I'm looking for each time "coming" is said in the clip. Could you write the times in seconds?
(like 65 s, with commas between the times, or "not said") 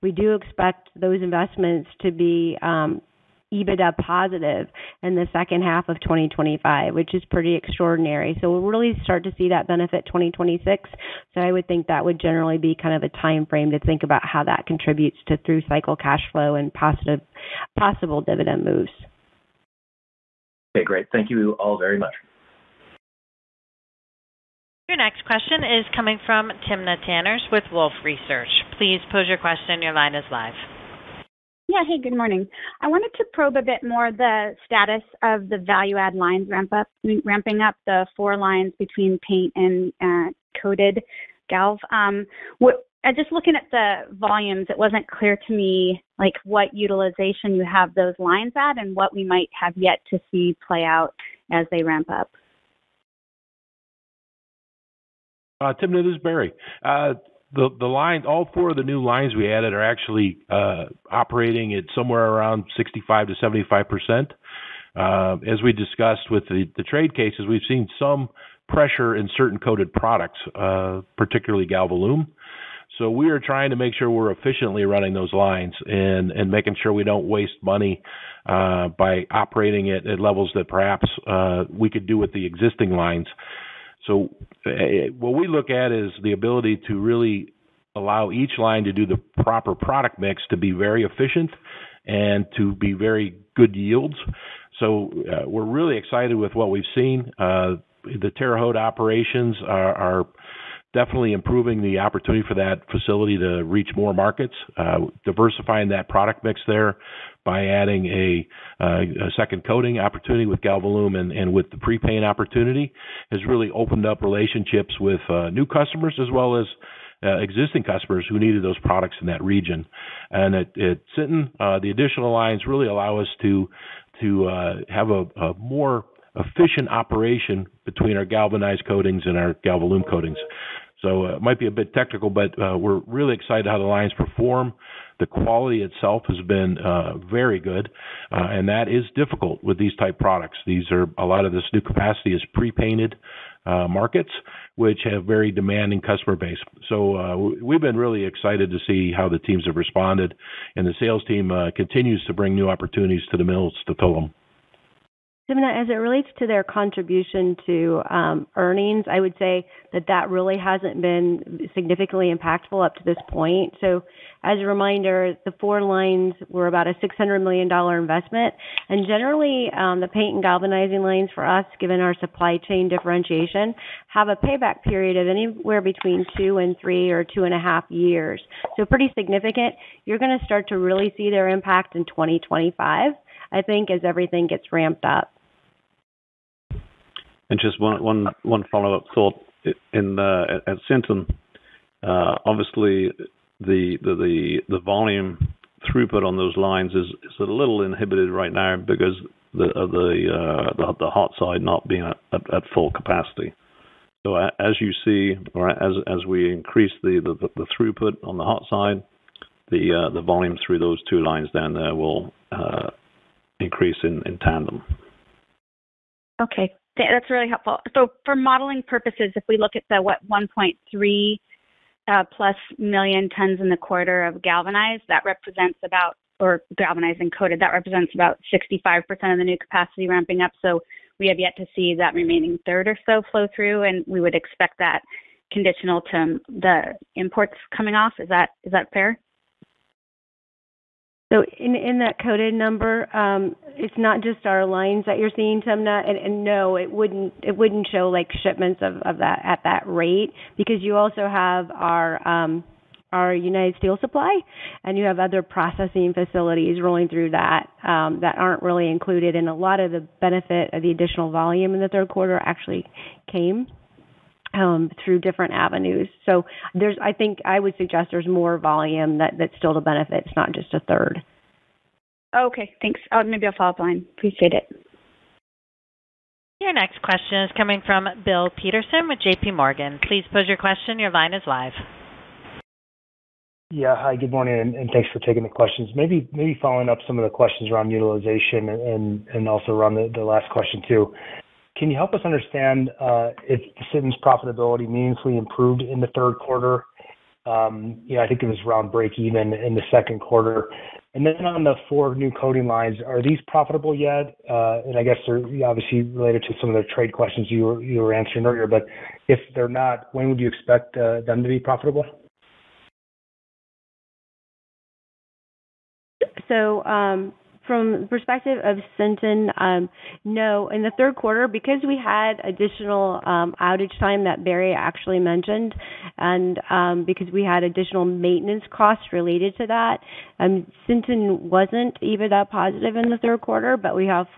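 25 s, 237 s, 277 s.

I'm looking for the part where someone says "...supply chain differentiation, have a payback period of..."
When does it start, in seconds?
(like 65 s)
172 s.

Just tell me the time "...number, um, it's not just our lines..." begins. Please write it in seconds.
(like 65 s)
242 s.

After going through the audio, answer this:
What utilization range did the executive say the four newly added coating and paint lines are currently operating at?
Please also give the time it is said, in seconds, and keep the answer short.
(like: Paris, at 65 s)
65 to 75 percent, at 62 s.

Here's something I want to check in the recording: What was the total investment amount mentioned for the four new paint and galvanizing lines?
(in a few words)
$600 million.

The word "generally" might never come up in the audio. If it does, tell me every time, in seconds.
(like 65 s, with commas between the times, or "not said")
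12 s, 169 s.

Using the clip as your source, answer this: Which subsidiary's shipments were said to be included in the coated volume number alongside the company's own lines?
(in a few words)
United Steel Supply.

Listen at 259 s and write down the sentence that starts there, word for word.
And a lot of the benefit of the additional volume in the third quarter actually came um, through different avenues.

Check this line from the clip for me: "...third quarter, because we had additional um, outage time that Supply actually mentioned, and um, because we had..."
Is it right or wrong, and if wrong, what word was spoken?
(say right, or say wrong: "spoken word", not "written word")
wrong: "Barry", not "Supply".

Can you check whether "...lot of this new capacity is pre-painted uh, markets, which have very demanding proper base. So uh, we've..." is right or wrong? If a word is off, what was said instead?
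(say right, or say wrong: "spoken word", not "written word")
wrong: "customer", not "proper".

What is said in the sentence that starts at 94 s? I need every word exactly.
So uh, we're really excited with what we've seen.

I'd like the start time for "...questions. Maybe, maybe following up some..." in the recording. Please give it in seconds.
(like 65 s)
285 s.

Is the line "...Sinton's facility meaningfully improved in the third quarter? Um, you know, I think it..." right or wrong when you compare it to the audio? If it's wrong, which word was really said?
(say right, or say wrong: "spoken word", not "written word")
wrong: "profitability", not "facility".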